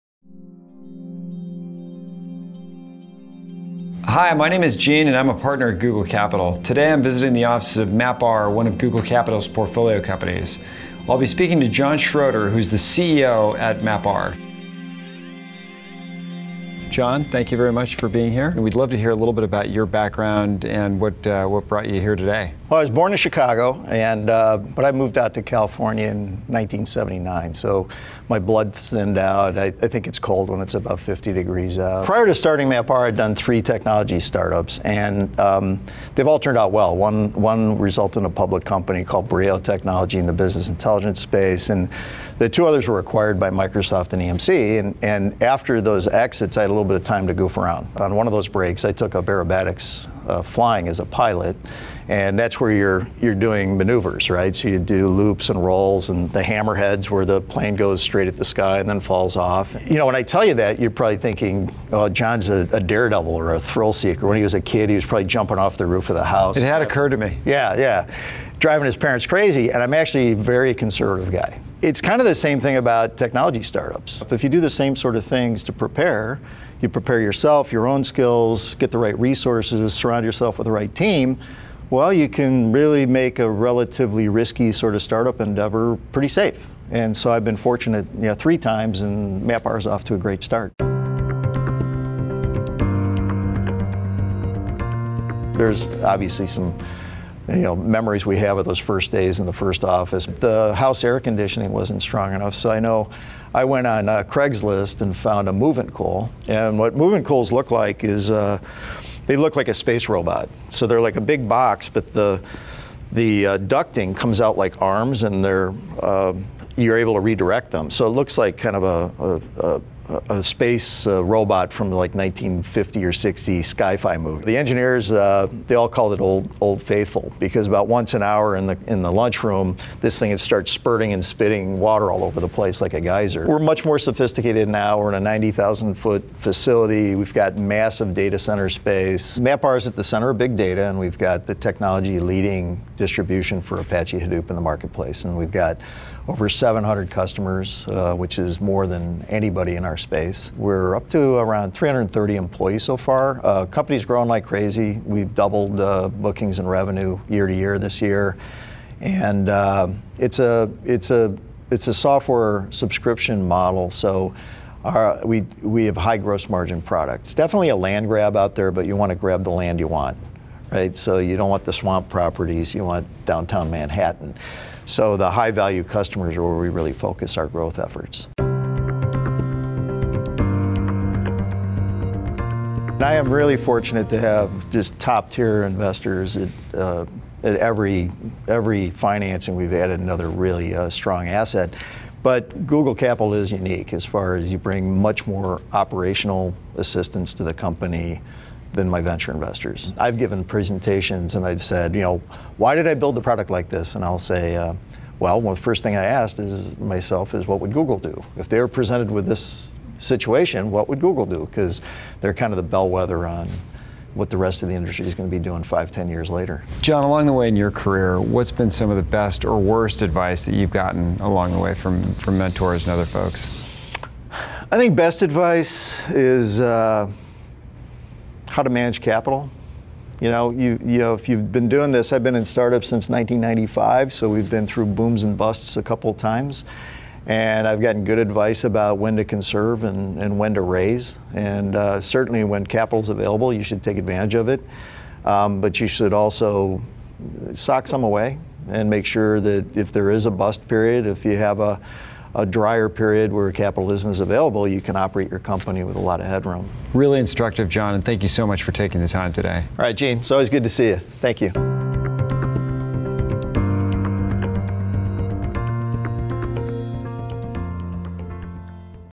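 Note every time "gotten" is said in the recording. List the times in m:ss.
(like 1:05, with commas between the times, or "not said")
3:40, 3:57.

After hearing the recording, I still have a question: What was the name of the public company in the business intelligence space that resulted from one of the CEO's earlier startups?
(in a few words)
Brio Technology.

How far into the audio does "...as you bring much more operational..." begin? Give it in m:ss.
3:14.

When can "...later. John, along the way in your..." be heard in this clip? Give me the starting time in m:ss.
3:36.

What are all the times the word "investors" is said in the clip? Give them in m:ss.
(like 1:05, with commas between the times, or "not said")
3:05, 3:19.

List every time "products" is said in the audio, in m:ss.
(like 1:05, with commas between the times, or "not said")
2:46, 3:23.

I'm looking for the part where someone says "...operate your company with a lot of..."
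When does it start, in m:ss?
4:14.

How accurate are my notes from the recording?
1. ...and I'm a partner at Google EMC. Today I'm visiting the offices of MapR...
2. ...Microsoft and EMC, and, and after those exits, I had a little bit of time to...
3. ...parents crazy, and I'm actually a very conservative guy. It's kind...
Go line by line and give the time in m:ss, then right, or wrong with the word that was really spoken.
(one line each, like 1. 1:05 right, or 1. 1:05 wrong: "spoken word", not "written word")
1. 0:05 wrong: "Capital", not "EMC"
2. 0:43 right
3. 1:08 right.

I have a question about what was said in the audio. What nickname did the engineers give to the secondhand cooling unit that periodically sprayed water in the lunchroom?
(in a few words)
Old Faithful.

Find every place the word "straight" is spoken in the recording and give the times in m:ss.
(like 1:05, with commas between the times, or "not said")
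0:58.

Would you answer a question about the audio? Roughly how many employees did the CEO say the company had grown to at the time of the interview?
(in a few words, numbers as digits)
330.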